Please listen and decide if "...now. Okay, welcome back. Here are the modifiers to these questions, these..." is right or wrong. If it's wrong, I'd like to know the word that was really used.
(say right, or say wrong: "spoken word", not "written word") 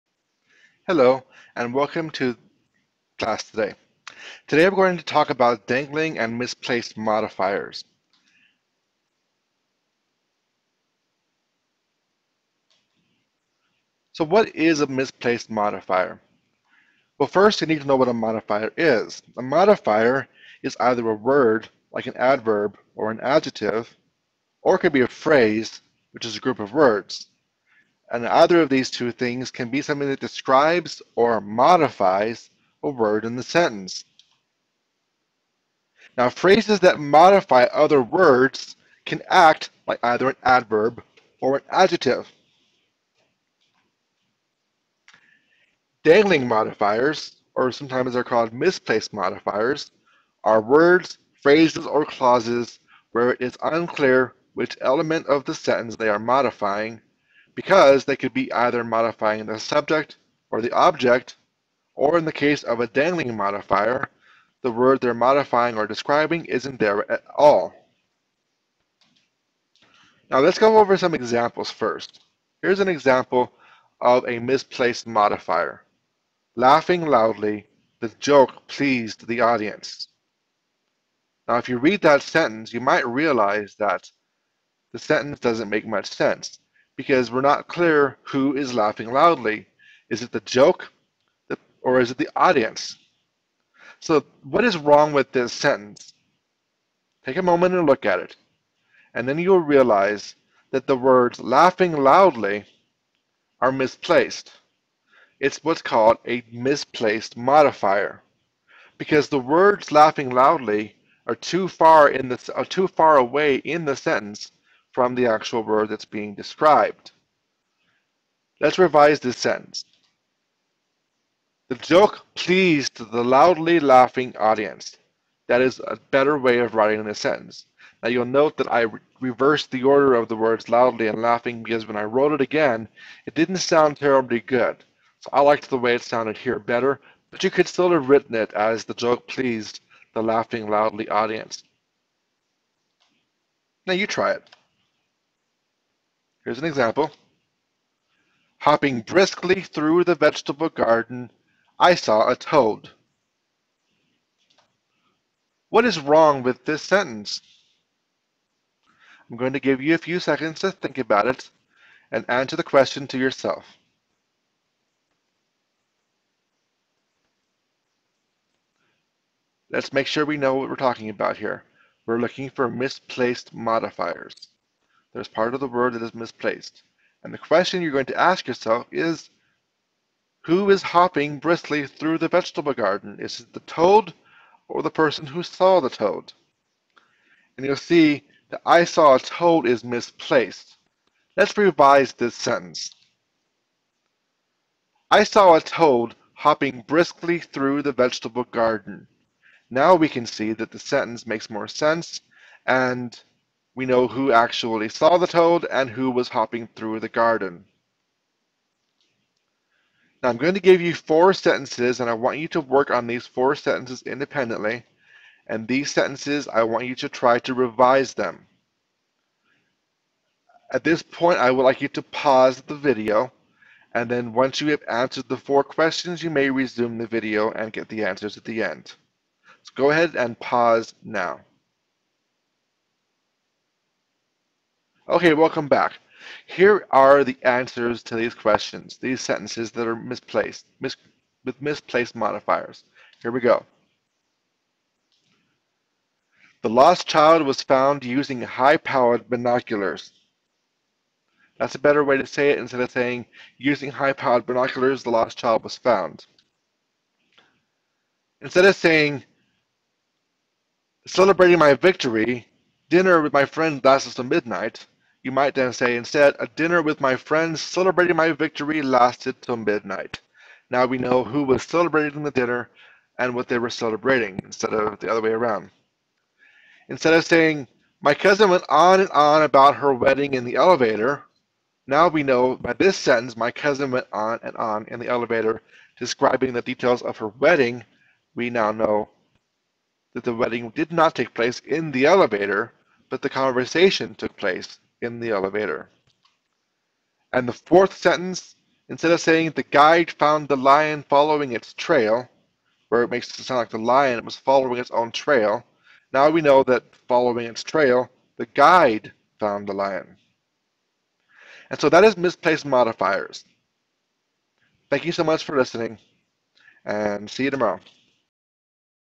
wrong: "answers", not "modifiers".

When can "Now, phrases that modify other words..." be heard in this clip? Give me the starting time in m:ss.
0:36.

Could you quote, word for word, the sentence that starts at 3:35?
And these sentences, I want you to try to revise them.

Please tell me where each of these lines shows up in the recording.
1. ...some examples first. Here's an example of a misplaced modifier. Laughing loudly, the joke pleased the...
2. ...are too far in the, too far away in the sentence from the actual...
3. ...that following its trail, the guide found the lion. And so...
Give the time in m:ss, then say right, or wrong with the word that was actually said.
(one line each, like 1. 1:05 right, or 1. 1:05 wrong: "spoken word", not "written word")
1. 1:10 right
2. 1:51 right
3. 5:06 right.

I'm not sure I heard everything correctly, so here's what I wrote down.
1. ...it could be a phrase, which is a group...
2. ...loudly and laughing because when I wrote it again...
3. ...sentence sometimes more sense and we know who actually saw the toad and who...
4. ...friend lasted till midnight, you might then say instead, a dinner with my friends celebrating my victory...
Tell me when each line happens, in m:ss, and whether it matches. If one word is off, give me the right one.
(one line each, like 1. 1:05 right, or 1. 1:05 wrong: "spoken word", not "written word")
1. 0:24 right
2. 2:10 right
3. 3:20 wrong: "makes", not "sometimes"
4. 4:23 right.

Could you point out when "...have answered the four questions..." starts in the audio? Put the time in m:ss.
3:44.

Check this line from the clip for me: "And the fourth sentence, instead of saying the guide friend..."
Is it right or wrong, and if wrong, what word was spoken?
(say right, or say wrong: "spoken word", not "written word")
wrong: "found", not "friend".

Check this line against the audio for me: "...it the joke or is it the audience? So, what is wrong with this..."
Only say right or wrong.
right.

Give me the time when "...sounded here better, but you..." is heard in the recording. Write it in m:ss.
2:16.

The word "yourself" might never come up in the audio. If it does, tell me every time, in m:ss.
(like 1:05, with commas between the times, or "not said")
2:43, 2:58.